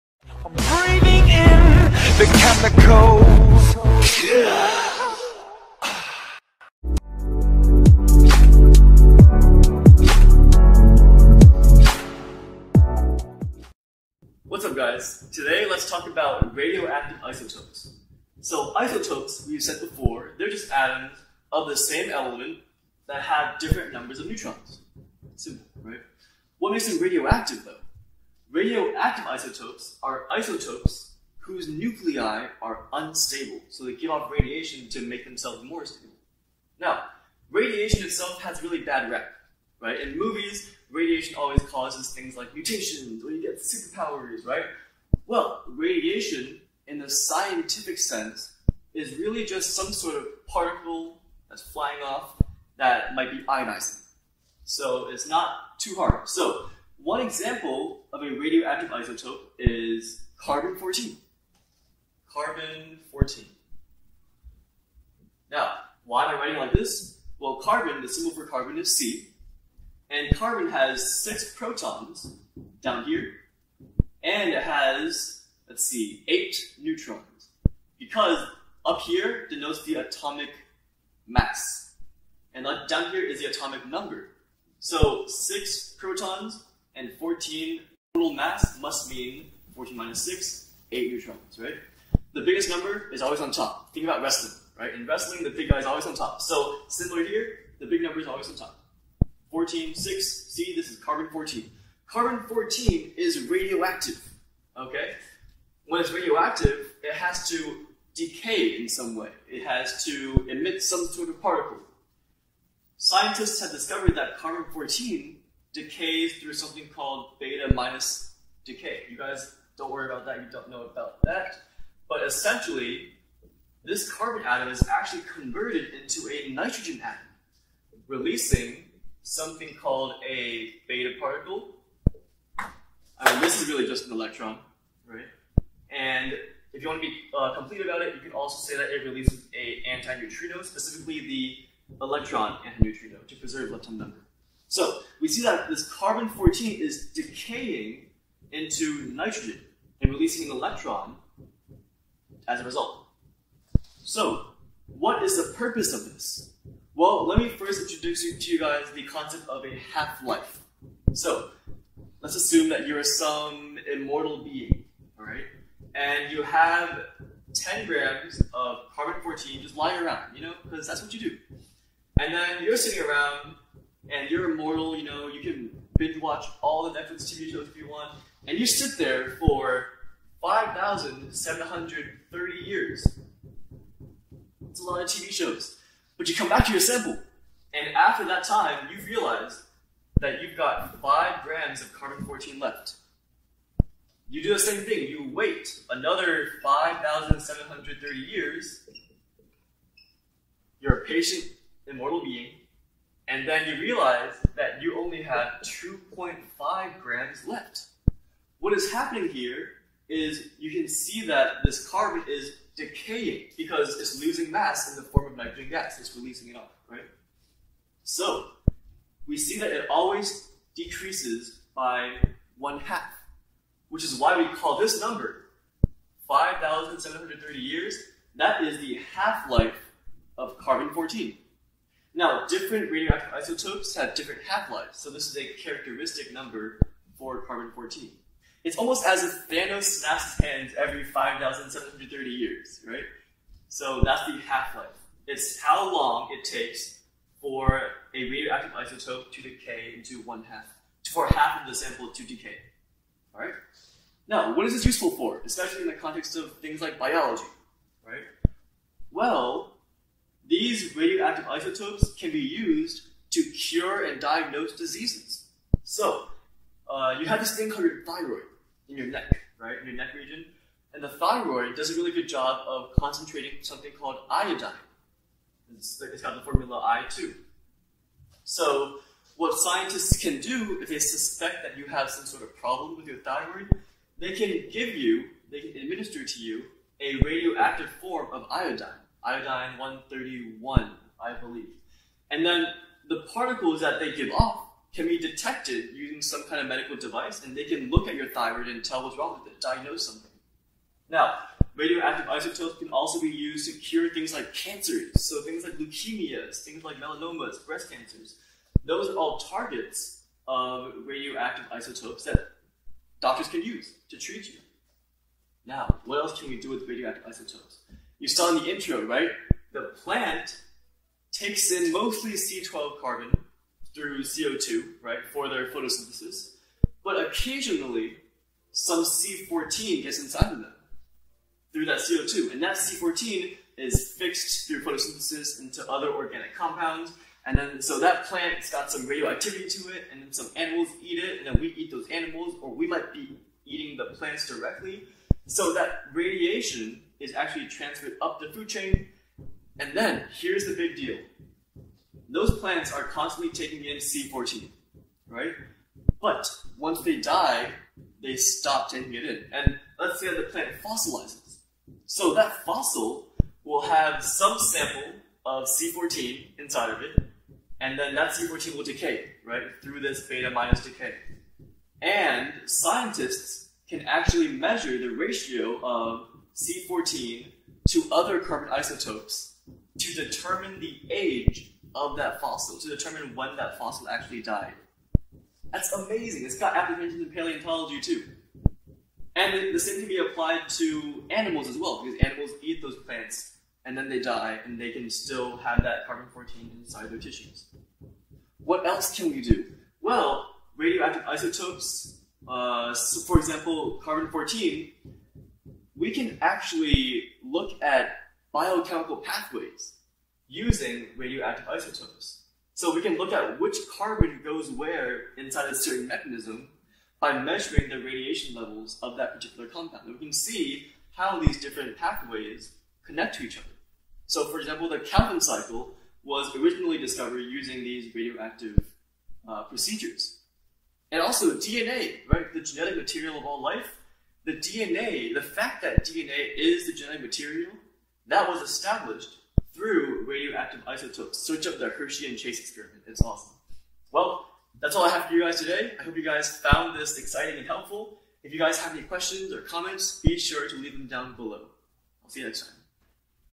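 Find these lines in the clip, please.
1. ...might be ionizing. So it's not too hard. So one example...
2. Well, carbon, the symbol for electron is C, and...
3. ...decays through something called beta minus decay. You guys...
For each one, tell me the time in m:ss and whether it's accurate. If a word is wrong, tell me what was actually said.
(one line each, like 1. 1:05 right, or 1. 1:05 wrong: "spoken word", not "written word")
1. 0:53 right
2. 1:07 wrong: "carbon", not "electron"
3. 1:55 right.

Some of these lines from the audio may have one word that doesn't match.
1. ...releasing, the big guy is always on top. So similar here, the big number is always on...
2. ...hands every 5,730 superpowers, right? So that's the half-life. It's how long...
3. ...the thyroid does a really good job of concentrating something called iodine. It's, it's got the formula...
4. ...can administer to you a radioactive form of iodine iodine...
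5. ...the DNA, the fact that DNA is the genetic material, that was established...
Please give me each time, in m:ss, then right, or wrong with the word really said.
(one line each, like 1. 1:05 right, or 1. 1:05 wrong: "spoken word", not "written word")
1. 1:35 wrong: "wrestling", not "releasing"
2. 4:00 wrong: "years", not "superpowers"
3. 4:31 right
4. 4:45 right
5. 7:14 right.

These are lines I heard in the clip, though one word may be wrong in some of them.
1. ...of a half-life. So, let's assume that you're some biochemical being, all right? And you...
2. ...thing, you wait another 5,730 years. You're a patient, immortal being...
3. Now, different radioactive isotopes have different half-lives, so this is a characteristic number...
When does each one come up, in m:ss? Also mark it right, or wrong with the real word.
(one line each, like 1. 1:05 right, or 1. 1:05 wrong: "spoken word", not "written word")
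1. 2:39 wrong: "immortal", not "biochemical"
2. 3:14 right
3. 3:52 right.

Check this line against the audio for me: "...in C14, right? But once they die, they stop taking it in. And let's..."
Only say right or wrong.
right.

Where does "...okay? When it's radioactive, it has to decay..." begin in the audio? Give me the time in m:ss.
1:44.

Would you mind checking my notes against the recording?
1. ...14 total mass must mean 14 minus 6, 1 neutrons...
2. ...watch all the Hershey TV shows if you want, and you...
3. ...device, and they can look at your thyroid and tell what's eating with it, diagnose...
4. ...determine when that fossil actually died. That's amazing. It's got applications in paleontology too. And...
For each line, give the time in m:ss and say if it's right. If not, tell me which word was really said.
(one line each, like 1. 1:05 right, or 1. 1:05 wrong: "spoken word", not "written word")
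1. 1:27 wrong: "8", not "1"
2. 2:56 wrong: "Netflix", not "Hershey"
3. 4:56 wrong: "wrong", not "eating"
4. 6:22 right.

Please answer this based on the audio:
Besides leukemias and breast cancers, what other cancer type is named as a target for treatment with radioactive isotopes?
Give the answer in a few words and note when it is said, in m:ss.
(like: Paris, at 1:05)
Melanomas, at 5:06.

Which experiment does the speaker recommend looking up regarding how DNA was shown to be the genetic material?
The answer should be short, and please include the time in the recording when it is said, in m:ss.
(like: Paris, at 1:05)
Hershey and Chase experiment, at 7:21.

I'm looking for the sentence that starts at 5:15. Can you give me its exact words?
Now, what else can we do with radioactive isotopes?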